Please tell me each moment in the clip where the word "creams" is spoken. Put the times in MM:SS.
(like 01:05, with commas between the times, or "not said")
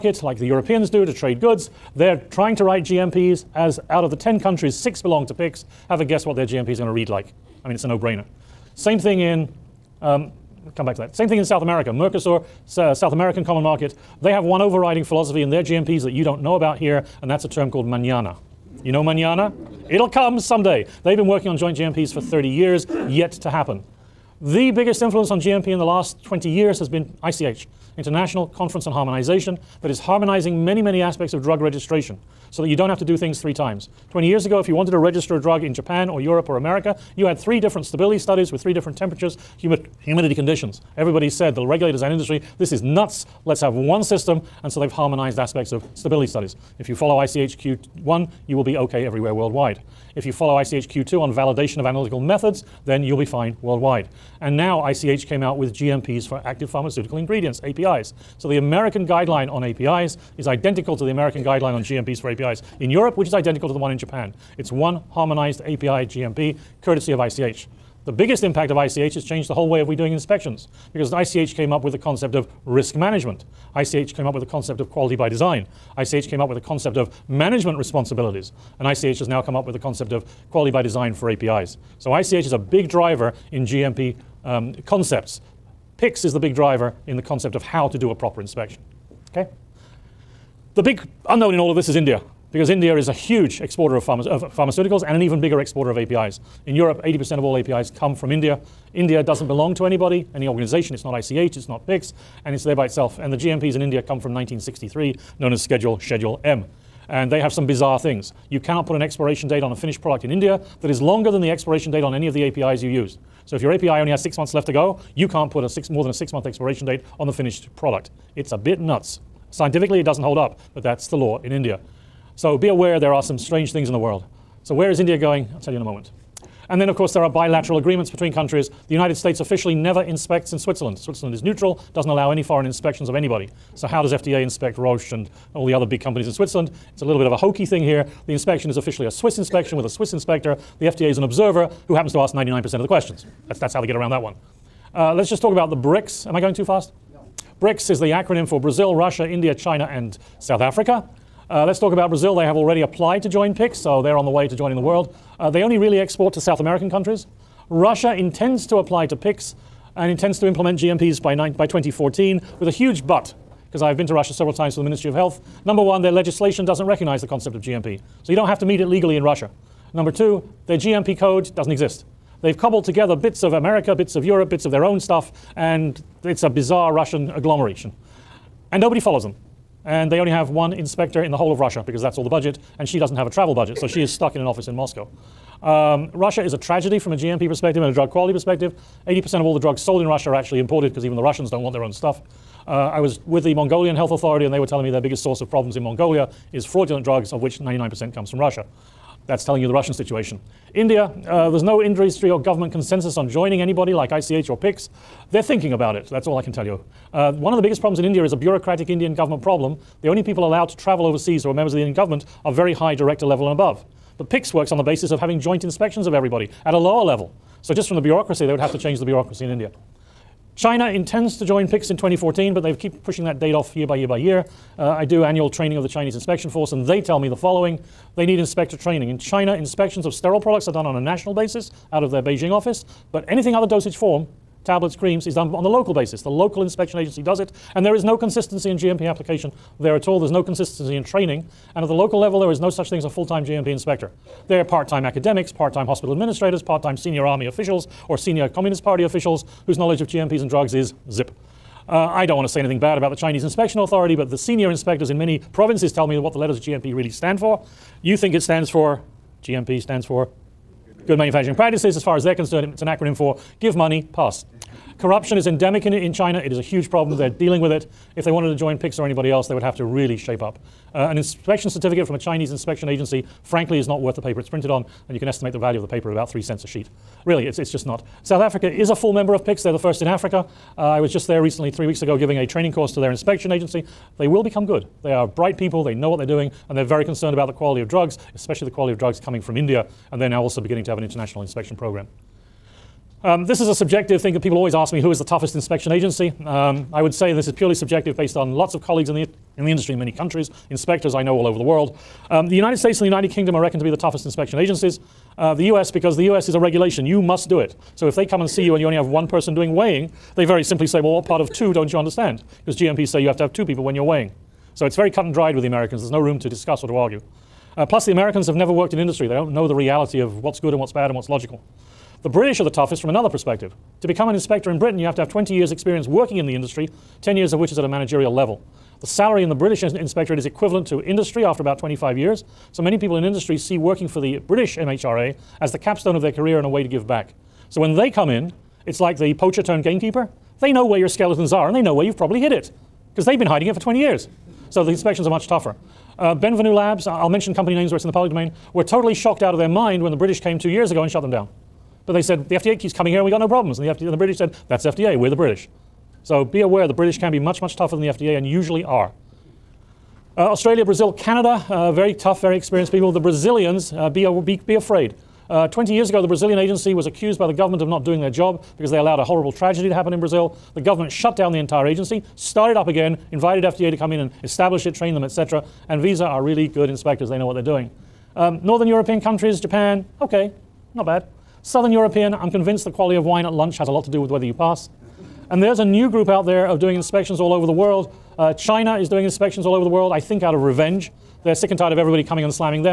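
03:54.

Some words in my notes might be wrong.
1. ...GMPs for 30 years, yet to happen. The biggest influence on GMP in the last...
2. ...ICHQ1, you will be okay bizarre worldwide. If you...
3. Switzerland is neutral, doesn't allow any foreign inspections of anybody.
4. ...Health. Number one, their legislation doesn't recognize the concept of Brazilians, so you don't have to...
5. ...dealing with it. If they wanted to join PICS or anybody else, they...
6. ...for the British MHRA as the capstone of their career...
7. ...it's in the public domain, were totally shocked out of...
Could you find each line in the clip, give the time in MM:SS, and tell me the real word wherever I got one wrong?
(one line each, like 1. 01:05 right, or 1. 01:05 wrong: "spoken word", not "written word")
1. 00:21 right
2. 00:47 wrong: "everywhere", not "bizarre"
3. 02:10 right
4. 02:45 wrong: "GMP", not "Brazilians"
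5. 04:27 right
6. 05:34 right
7. 05:47 right.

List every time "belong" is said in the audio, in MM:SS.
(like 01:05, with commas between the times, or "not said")
00:04, 01:39.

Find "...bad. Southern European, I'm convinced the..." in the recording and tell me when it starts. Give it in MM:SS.
06:21.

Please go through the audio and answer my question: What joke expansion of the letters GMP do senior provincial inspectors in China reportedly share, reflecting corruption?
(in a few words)
Give Money, Pass.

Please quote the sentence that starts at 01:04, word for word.
It's one harmonized API GMP, courtesy of ICH.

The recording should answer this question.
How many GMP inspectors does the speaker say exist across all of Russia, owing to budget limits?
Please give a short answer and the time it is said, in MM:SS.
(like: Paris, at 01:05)
1, at 03:00.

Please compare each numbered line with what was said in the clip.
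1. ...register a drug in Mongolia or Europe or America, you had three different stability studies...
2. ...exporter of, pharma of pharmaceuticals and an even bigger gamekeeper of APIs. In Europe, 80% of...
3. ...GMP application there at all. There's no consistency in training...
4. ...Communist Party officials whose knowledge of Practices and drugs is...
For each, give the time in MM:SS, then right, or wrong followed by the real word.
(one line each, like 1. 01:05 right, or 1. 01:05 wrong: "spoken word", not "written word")
1. 00:34 wrong: "Japan", not "Mongolia"
2. 01:33 wrong: "exporter", not "gamekeeper"
3. 03:58 right
4. 04:08 wrong: "GMPs", not "Practices".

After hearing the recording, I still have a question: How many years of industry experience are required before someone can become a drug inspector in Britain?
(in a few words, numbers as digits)
20 years.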